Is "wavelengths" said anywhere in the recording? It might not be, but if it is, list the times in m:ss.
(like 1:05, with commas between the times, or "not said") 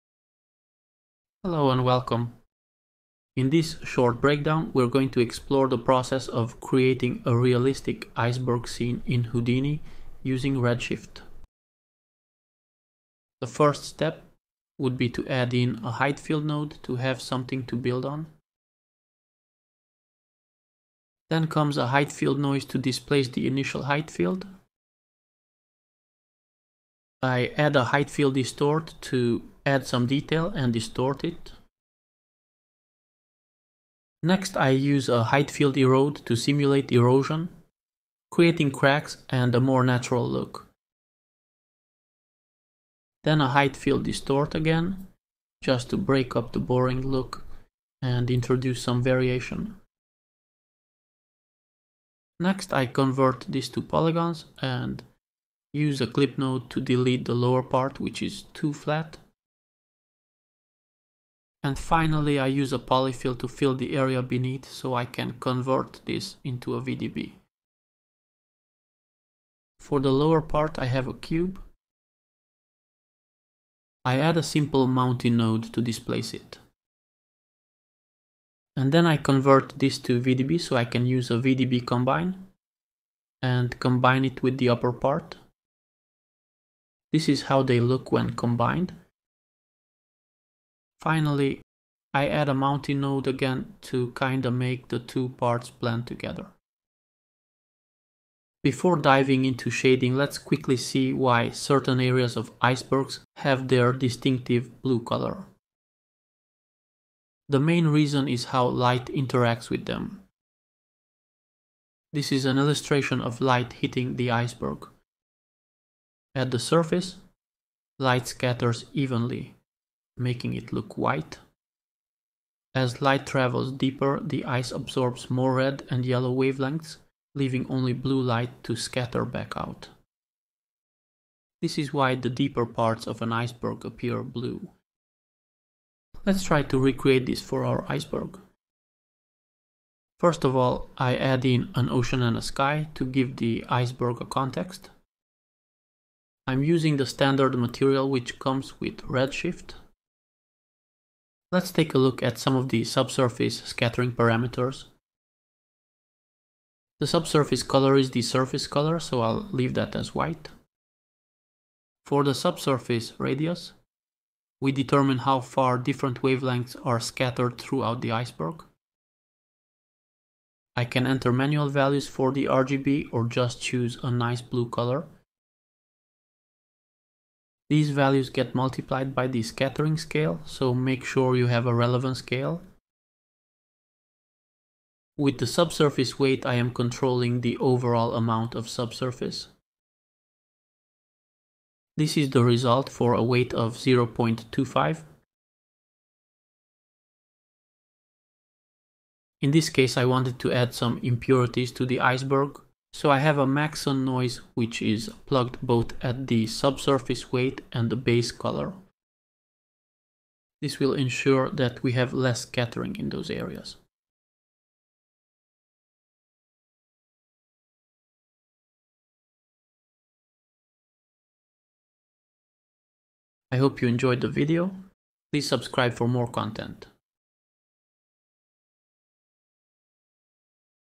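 2:06, 2:46.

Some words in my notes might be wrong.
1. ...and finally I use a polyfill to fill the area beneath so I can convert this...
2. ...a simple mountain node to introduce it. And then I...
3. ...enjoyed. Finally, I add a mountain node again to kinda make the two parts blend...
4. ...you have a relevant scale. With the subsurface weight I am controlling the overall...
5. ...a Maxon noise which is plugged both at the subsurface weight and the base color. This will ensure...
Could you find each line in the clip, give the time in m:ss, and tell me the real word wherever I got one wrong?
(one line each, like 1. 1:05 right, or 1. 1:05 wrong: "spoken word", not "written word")
1. 1:01 right
2. 1:14 wrong: "displace", not "introduce"
3. 1:28 wrong: "combined", not "enjoyed"
4. 3:01 right
5. 3:23 right.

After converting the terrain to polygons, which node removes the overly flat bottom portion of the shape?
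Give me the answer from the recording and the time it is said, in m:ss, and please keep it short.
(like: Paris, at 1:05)
clip node, at 0:56.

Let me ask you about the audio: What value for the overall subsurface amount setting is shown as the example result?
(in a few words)
0.25.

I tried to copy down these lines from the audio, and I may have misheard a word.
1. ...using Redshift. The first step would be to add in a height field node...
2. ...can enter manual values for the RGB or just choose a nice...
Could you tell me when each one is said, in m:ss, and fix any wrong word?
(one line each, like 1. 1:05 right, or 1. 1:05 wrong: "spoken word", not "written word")
1. 0:10 right
2. 2:50 right.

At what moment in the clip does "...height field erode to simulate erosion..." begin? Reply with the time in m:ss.
0:35.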